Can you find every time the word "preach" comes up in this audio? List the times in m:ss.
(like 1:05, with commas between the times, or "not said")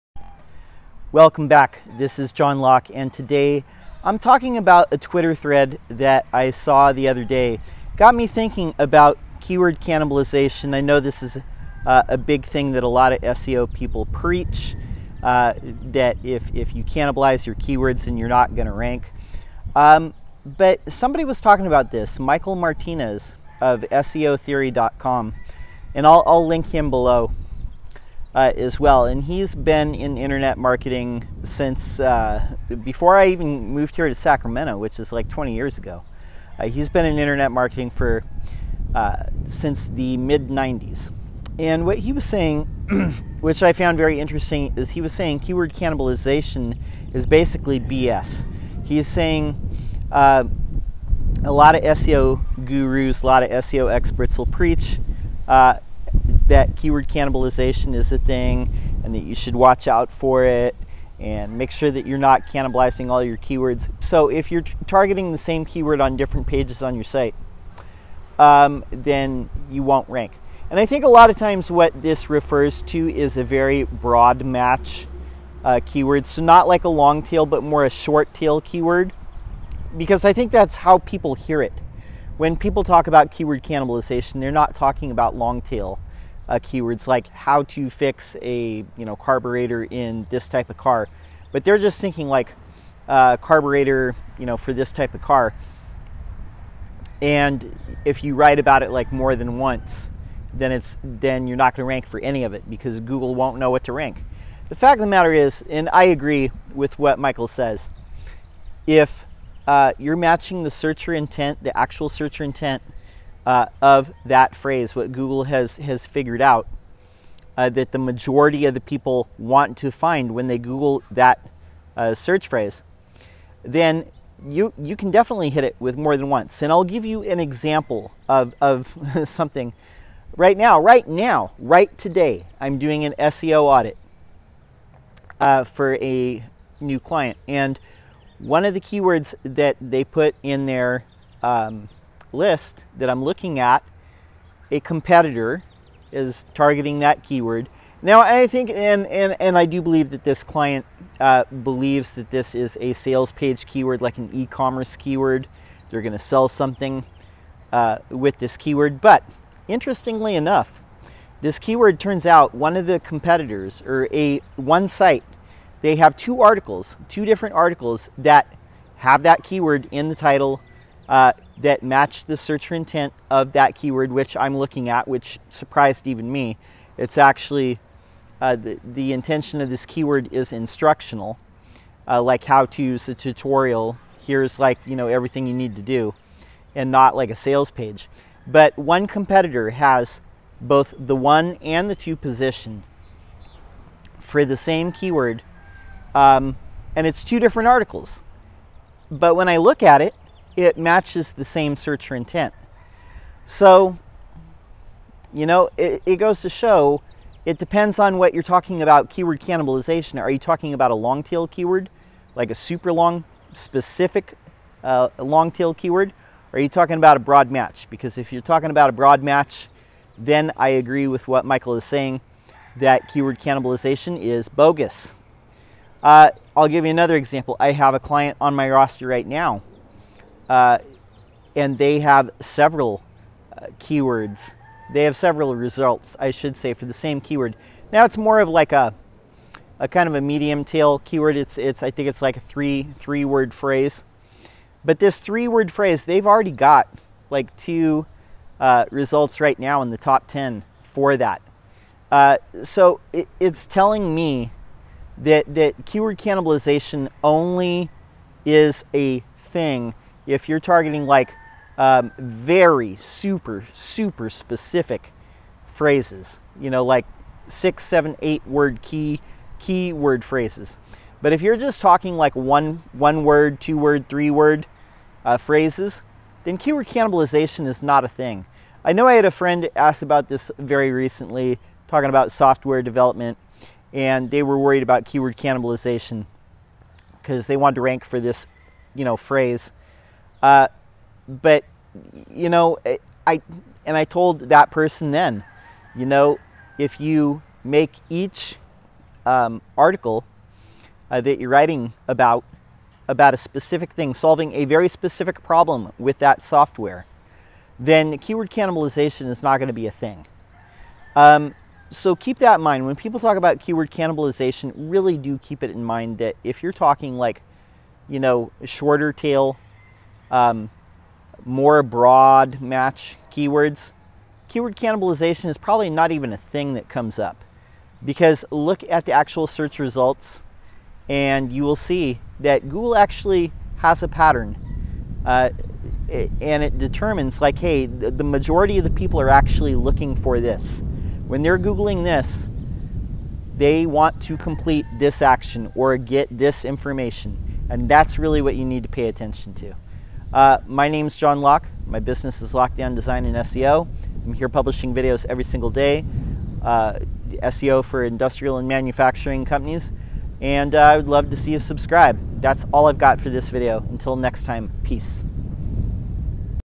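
0:14, 0:54.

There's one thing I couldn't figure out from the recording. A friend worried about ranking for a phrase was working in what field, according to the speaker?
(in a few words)
Software development.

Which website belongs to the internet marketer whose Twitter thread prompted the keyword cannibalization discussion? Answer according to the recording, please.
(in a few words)
SEOtheory.com.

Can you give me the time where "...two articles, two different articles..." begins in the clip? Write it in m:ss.
2:46.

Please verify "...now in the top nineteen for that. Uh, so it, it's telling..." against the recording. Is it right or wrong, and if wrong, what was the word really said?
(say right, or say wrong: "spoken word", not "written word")
wrong: "ten", not "nineteen".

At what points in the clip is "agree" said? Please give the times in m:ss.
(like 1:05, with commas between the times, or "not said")
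1:46, 3:40.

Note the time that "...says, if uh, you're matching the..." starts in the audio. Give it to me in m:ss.
1:47.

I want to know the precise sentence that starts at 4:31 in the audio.
But if you're just talking like one, one word, two word, three word uh, phrases, then keyword cannibalization is not a thing.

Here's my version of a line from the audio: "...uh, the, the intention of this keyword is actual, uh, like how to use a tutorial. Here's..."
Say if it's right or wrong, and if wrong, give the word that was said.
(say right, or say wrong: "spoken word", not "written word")
wrong: "instructional", not "actual".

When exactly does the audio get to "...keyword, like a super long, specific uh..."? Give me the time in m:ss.
3:31.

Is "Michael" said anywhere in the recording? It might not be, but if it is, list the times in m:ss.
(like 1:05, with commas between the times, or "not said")
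0:22, 1:47, 3:41.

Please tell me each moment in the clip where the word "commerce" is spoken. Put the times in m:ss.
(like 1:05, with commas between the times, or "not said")
2:34.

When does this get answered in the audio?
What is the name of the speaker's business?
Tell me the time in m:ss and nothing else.
5:52.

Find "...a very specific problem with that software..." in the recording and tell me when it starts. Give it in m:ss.
5:04.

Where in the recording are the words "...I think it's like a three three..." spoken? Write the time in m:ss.
4:01.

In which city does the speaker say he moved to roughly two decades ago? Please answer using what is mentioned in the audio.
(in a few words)
Sacramento.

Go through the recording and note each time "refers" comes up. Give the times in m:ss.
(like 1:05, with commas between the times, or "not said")
1:12.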